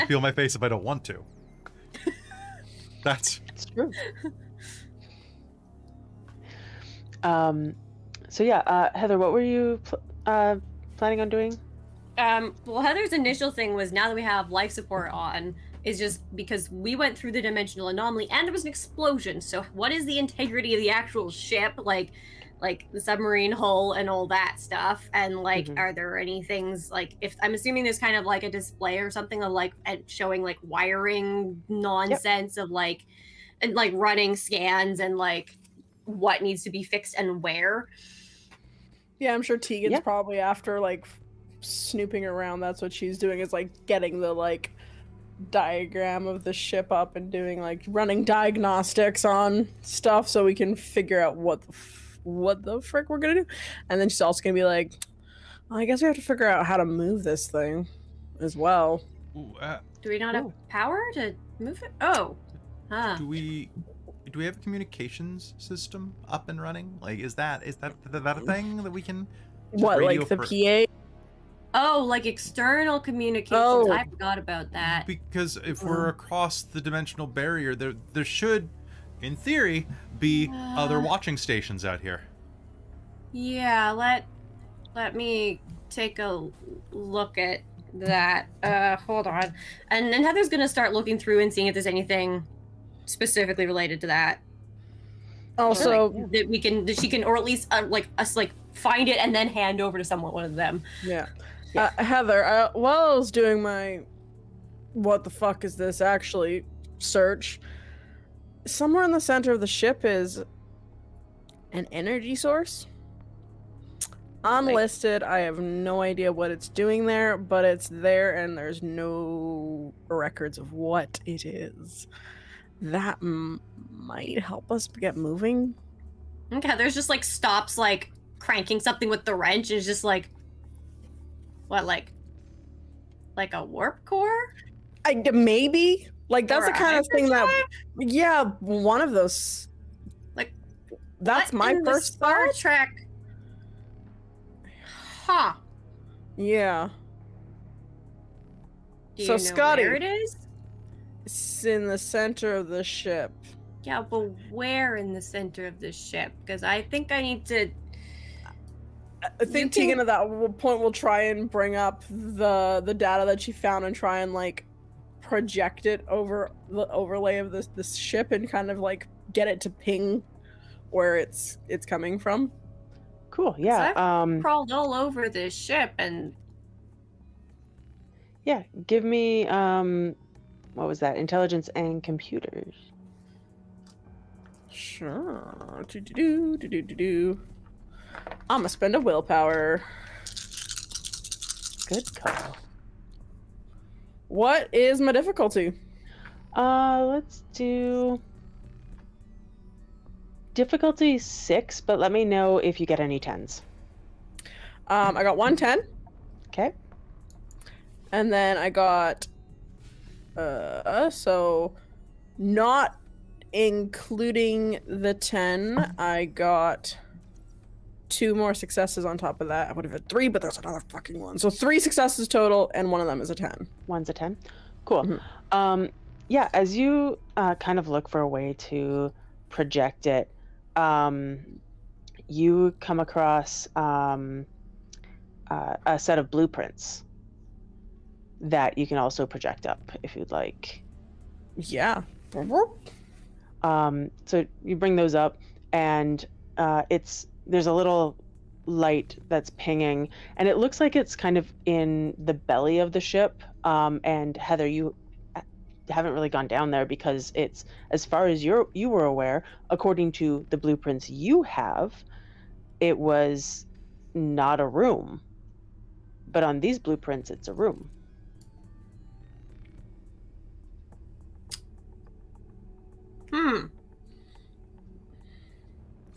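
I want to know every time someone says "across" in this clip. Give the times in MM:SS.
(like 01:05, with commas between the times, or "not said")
01:16, 03:53.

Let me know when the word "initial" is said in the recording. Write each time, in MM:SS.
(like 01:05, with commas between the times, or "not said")
00:13.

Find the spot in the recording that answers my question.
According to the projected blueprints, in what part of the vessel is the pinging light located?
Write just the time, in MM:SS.
04:12.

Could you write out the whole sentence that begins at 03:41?
So three successes total, and one of them is a 10.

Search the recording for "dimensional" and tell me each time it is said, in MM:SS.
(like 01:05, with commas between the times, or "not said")
00:17, 01:16.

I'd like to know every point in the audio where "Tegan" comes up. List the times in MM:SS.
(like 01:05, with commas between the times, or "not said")
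00:39, 02:39.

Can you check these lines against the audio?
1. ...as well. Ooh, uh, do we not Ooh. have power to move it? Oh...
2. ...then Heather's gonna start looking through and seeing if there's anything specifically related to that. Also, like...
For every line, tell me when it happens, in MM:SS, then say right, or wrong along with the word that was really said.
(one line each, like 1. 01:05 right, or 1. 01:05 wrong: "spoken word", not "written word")
1. 00:58 right
2. 01:30 right.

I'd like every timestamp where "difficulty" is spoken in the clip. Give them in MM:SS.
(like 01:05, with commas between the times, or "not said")
03:15, 03:20.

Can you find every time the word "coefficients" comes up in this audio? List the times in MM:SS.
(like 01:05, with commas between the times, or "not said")
not said.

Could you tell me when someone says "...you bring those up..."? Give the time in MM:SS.
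04:04.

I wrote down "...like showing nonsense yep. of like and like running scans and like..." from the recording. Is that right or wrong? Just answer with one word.
wrong.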